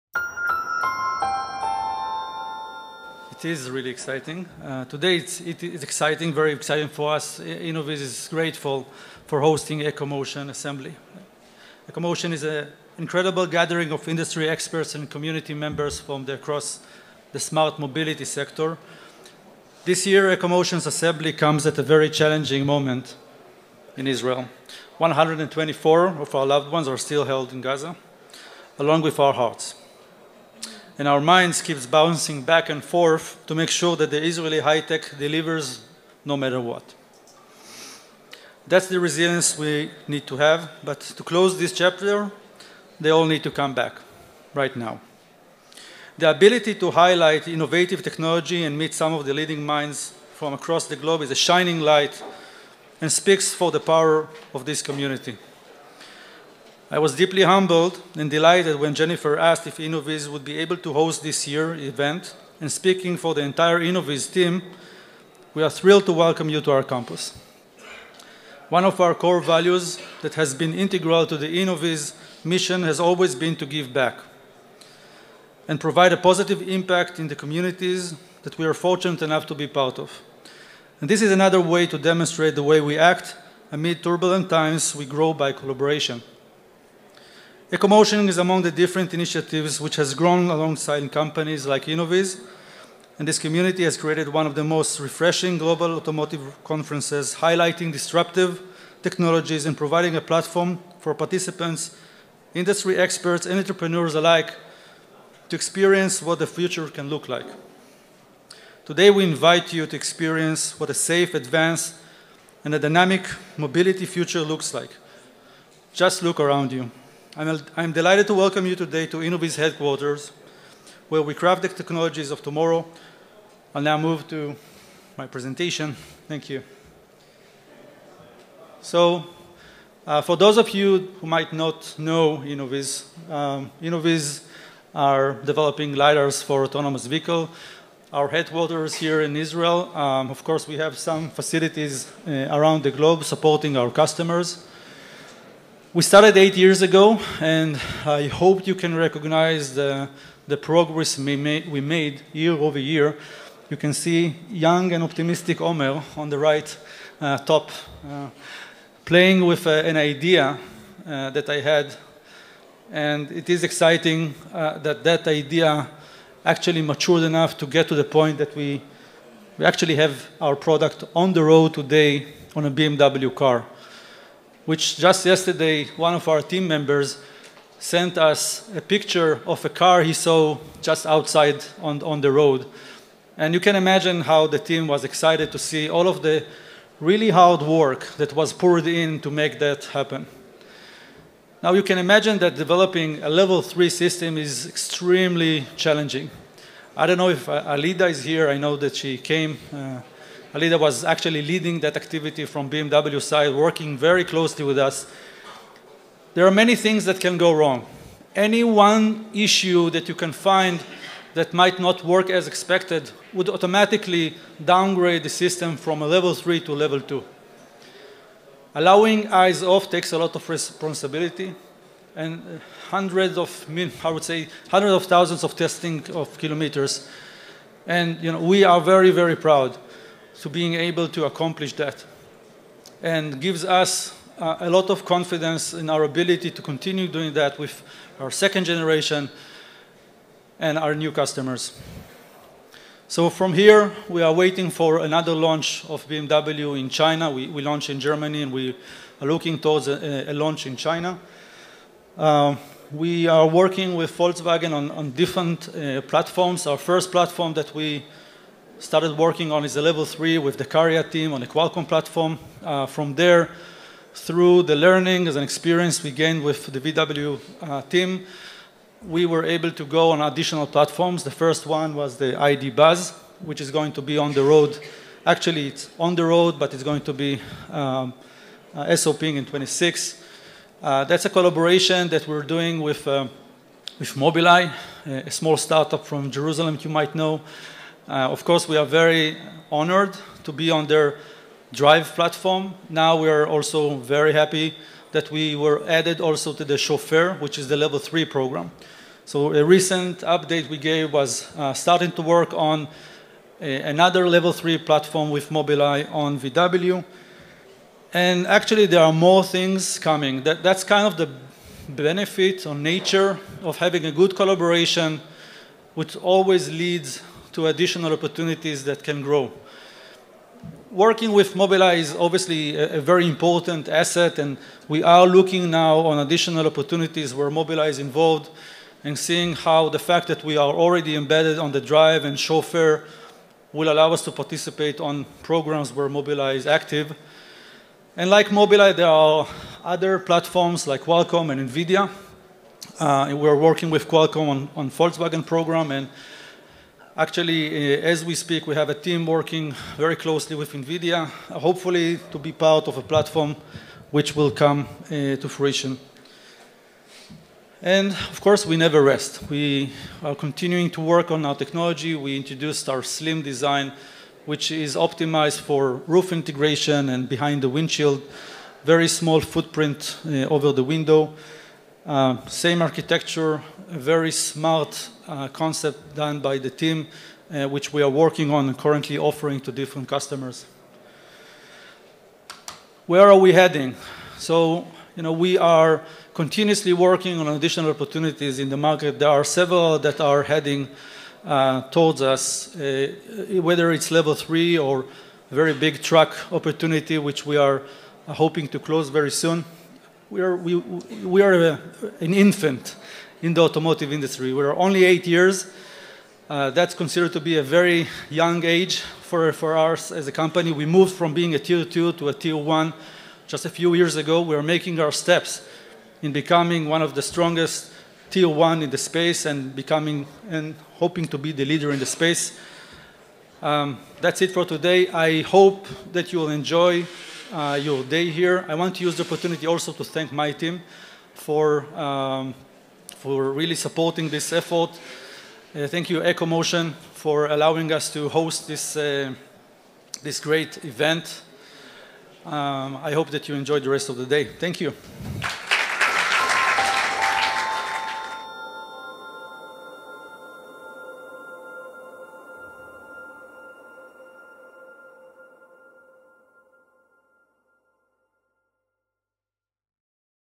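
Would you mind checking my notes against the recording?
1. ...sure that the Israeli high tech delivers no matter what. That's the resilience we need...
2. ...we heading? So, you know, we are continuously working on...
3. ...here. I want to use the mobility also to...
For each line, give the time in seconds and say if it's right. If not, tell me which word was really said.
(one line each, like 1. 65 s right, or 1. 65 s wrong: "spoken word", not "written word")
1. 33 s right
2. 383 s right
3. 428 s wrong: "opportunity", not "mobility".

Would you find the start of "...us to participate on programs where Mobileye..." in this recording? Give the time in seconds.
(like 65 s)
334 s.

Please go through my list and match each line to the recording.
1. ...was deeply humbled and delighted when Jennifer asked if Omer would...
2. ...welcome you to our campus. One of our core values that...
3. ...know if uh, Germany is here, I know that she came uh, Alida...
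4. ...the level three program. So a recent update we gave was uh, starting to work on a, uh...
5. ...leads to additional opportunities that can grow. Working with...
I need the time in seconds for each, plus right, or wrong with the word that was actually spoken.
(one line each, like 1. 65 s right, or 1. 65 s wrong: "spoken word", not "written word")
1. 56 s wrong: "Innoviz", not "Omer"
2. 66 s right
3. 197 s wrong: "Alida", not "Germany"
4. 297 s right
5. 316 s right.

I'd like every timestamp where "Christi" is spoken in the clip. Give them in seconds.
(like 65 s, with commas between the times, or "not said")
not said.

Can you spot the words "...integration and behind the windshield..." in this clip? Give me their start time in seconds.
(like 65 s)
366 s.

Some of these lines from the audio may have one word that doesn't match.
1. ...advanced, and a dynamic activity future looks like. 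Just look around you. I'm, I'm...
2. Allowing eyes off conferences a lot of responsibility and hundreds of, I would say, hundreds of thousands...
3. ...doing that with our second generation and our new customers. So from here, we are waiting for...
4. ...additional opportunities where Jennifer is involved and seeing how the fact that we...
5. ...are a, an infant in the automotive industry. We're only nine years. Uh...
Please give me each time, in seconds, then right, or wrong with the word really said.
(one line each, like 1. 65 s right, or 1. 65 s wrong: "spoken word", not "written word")
1. 111 s wrong: "mobility", not "activity"
2. 218 s wrong: "takes", not "conferences"
3. 237 s right
4. 326 s wrong: "Mobileye", not "Jennifer"
5. 401 s wrong: "eight", not "nine".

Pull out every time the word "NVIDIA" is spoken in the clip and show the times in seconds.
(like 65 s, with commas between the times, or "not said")
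341 s, 350 s.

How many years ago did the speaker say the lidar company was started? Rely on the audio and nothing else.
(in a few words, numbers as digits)
8 years.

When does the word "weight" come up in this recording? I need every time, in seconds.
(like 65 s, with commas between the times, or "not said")
not said.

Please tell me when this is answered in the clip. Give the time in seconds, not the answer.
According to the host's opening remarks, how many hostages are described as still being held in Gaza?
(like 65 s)
24 s.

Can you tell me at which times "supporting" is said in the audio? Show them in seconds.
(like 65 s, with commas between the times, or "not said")
143 s, 433 s.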